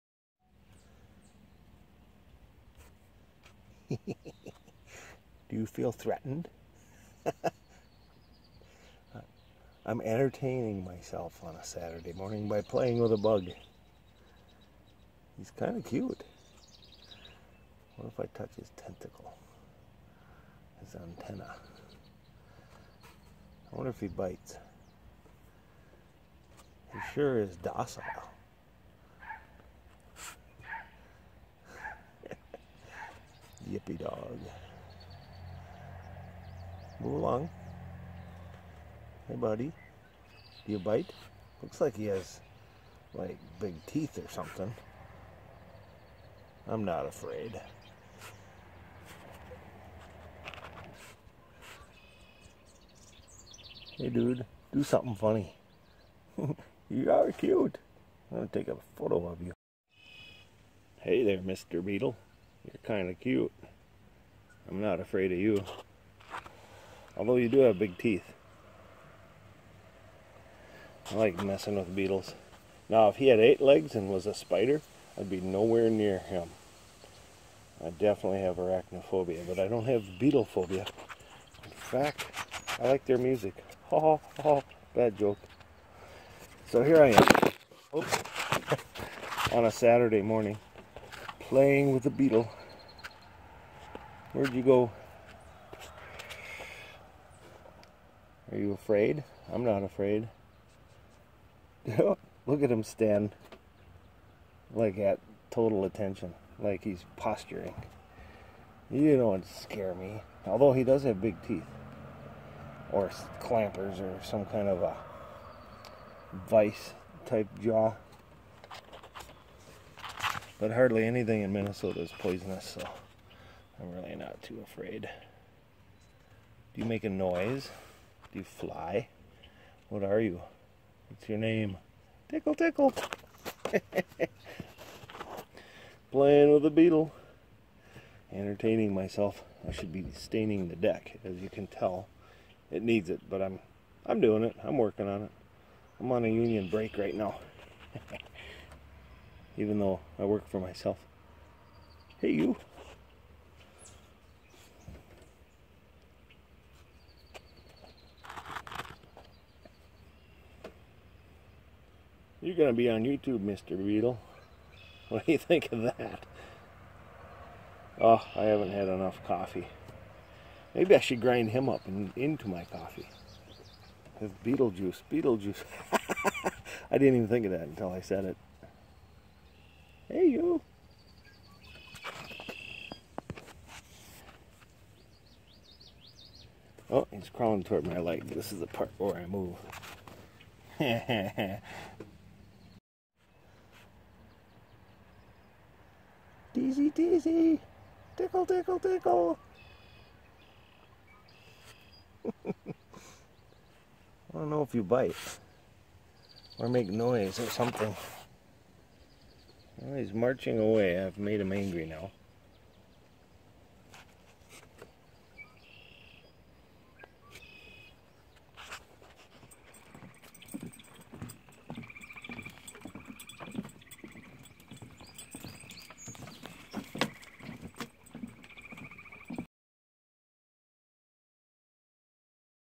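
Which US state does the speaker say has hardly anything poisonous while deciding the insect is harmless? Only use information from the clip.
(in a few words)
Minnesota.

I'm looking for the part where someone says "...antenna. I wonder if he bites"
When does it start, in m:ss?
0:20.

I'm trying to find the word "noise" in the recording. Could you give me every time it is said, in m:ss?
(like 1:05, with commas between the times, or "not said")
2:07, 3:26.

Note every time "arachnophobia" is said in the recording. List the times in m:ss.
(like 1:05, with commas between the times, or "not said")
1:18.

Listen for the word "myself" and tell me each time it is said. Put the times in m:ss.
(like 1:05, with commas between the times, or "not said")
0:10, 2:18, 2:30.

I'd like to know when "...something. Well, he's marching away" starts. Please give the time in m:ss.
3:27.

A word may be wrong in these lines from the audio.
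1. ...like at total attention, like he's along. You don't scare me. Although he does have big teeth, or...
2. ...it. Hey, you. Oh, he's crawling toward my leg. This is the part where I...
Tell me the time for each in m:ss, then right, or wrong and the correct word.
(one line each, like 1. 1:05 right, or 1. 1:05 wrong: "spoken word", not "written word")
1. 1:44 wrong: "posturing", not "along"
2. 2:58 right.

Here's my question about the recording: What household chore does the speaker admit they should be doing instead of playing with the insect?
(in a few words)
staining the deck.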